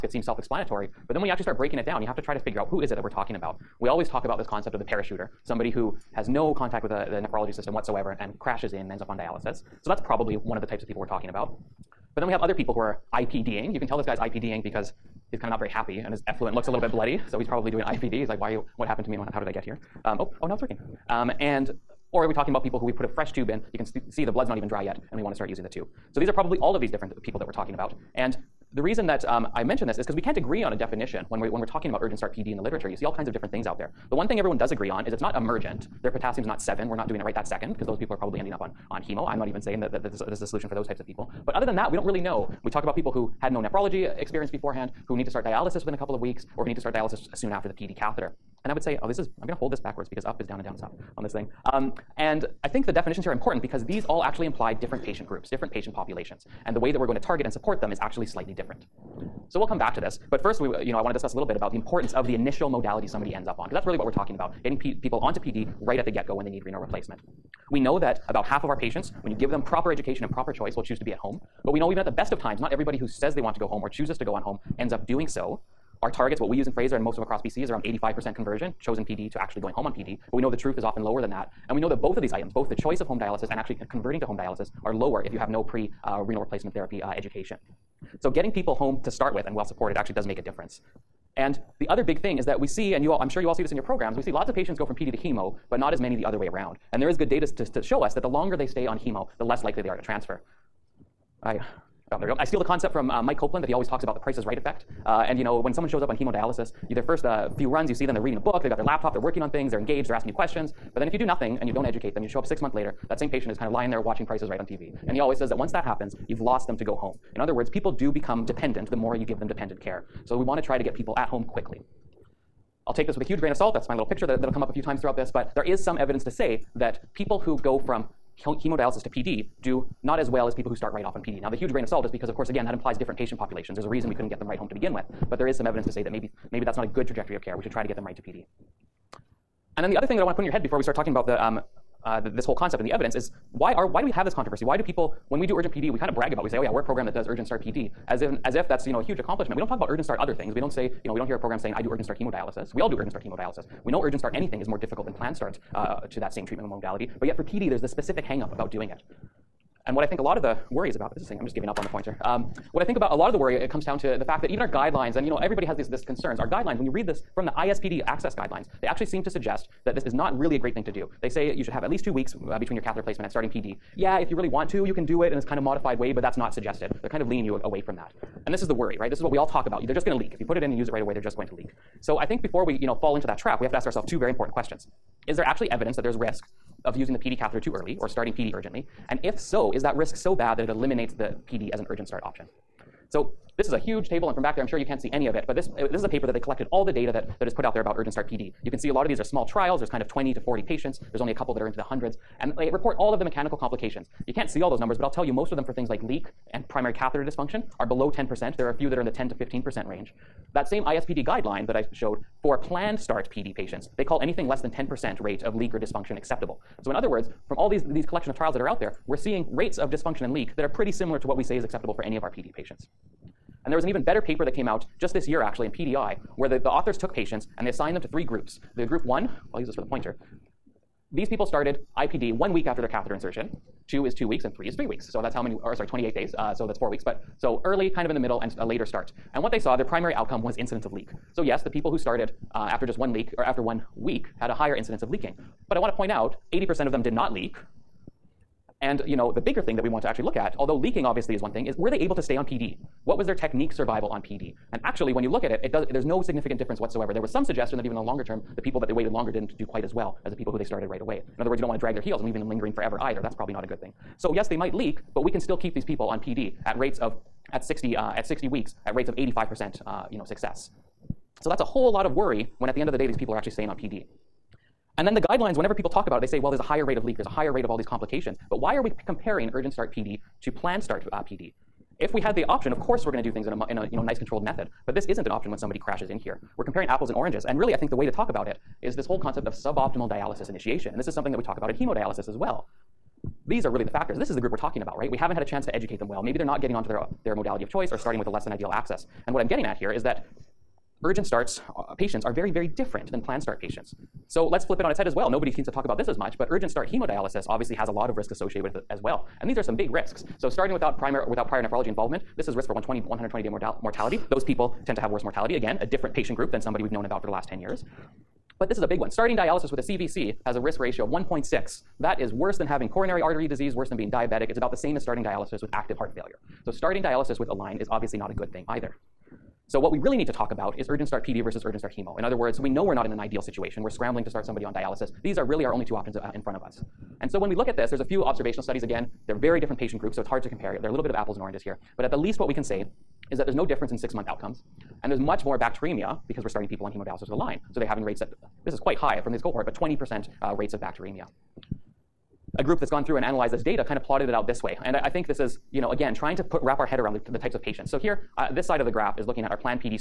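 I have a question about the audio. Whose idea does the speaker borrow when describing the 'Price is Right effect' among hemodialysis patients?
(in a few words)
Mike Copland.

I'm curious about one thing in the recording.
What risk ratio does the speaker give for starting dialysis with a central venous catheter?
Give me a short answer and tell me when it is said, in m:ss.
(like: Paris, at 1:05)
1.6, at 5:21.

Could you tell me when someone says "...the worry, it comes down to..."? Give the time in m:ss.
2:43.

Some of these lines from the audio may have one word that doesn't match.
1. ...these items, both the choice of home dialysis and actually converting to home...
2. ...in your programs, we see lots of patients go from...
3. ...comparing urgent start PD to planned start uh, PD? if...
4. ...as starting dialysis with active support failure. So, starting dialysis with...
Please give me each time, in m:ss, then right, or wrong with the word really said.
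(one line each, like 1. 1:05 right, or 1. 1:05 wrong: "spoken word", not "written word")
1. 1:22 right
2. 1:33 right
3. 4:39 right
4. 5:24 wrong: "heart", not "support".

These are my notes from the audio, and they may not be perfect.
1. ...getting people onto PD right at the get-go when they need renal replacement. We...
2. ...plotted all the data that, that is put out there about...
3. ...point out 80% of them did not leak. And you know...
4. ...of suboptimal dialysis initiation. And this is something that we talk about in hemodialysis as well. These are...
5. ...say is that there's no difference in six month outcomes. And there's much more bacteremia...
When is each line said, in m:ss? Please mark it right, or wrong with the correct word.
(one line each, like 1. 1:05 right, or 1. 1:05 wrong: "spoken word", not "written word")
1. 1:04 right
2. 3:16 wrong: "collected", not "plotted"
3. 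4:05 right
4. 4:49 right
5. 5:42 right.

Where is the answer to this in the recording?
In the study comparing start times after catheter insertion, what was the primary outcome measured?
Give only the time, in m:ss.
4:00.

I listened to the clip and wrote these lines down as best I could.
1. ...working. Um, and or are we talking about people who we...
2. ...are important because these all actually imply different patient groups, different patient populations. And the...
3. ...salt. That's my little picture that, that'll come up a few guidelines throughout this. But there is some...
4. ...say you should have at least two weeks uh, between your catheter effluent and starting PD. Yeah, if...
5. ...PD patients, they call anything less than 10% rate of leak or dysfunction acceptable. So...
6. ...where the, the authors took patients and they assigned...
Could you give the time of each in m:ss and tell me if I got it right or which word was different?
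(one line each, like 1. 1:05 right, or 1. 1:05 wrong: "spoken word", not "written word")
1. 0:20 right
2. 0:53 right
3. 2:03 wrong: "times", not "guidelines"
4. 2:51 wrong: "placement", not "effluent"
5. 3:33 right
6. 3:46 right.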